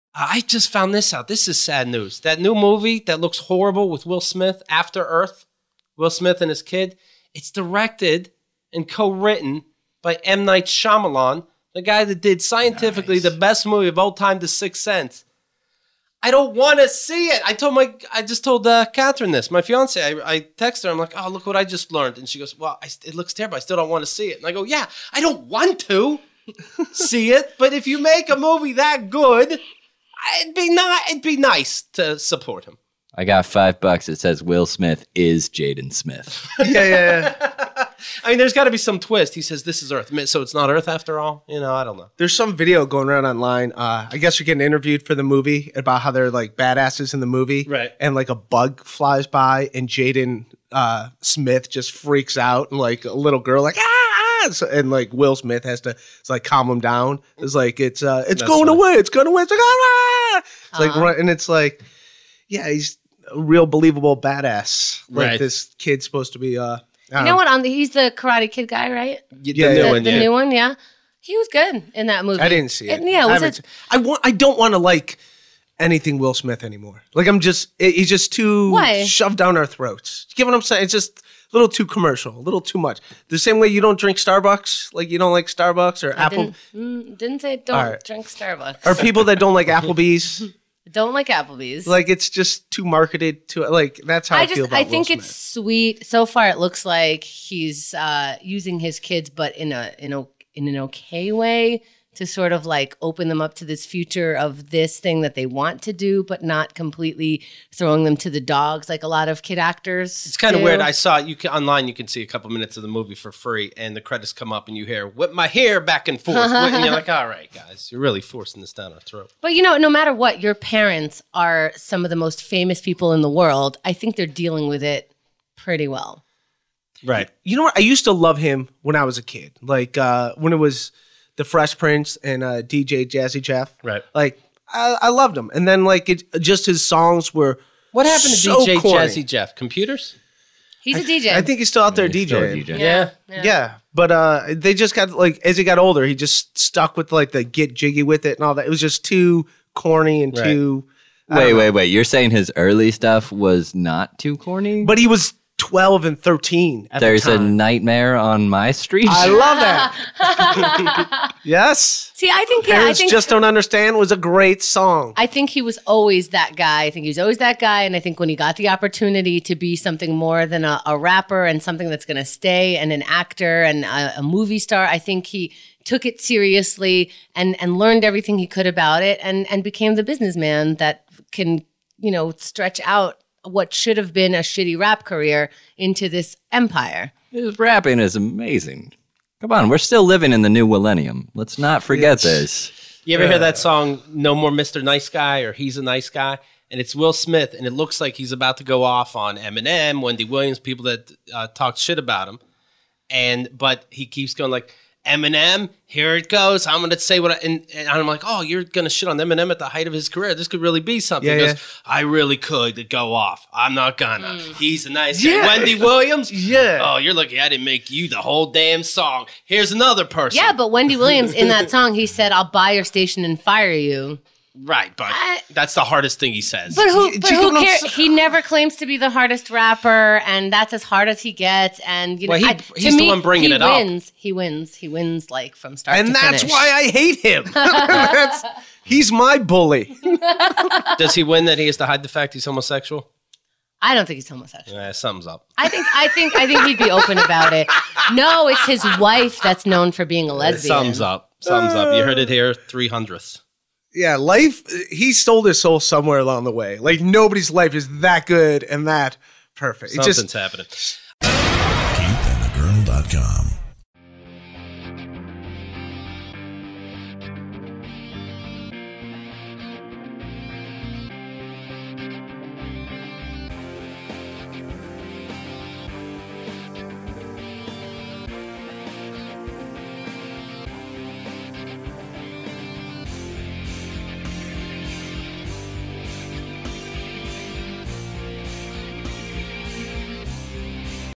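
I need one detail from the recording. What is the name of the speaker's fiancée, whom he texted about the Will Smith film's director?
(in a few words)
Catherine.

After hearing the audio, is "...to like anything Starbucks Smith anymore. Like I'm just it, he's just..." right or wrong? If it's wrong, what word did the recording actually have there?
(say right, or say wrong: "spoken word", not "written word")
wrong: "Will", not "Starbucks".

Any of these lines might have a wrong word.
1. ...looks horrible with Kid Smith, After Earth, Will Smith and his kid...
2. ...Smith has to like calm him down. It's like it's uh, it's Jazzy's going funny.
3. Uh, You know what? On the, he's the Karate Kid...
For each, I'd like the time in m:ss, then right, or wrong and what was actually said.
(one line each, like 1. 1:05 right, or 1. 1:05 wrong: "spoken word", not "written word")
1. 0:03 wrong: "Will", not "Kid"
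2. 0:55 wrong: "That", not "Jazzy"
3. 1:06 right.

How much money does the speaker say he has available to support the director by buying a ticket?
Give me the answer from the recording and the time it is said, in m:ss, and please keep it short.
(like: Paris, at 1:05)
5 bucks, at 0:33.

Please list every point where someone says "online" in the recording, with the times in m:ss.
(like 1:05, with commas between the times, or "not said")
0:43, 1:51.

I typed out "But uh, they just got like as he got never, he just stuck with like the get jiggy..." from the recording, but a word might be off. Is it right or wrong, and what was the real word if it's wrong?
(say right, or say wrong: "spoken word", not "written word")
wrong: "older", not "never".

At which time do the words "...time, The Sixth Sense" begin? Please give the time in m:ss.
0:14.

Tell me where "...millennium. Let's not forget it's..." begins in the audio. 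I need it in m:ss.
3:10.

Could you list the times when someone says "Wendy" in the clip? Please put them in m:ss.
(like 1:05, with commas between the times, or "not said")
3:20, 3:35, 3:40.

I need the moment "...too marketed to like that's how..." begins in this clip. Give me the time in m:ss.
1:32.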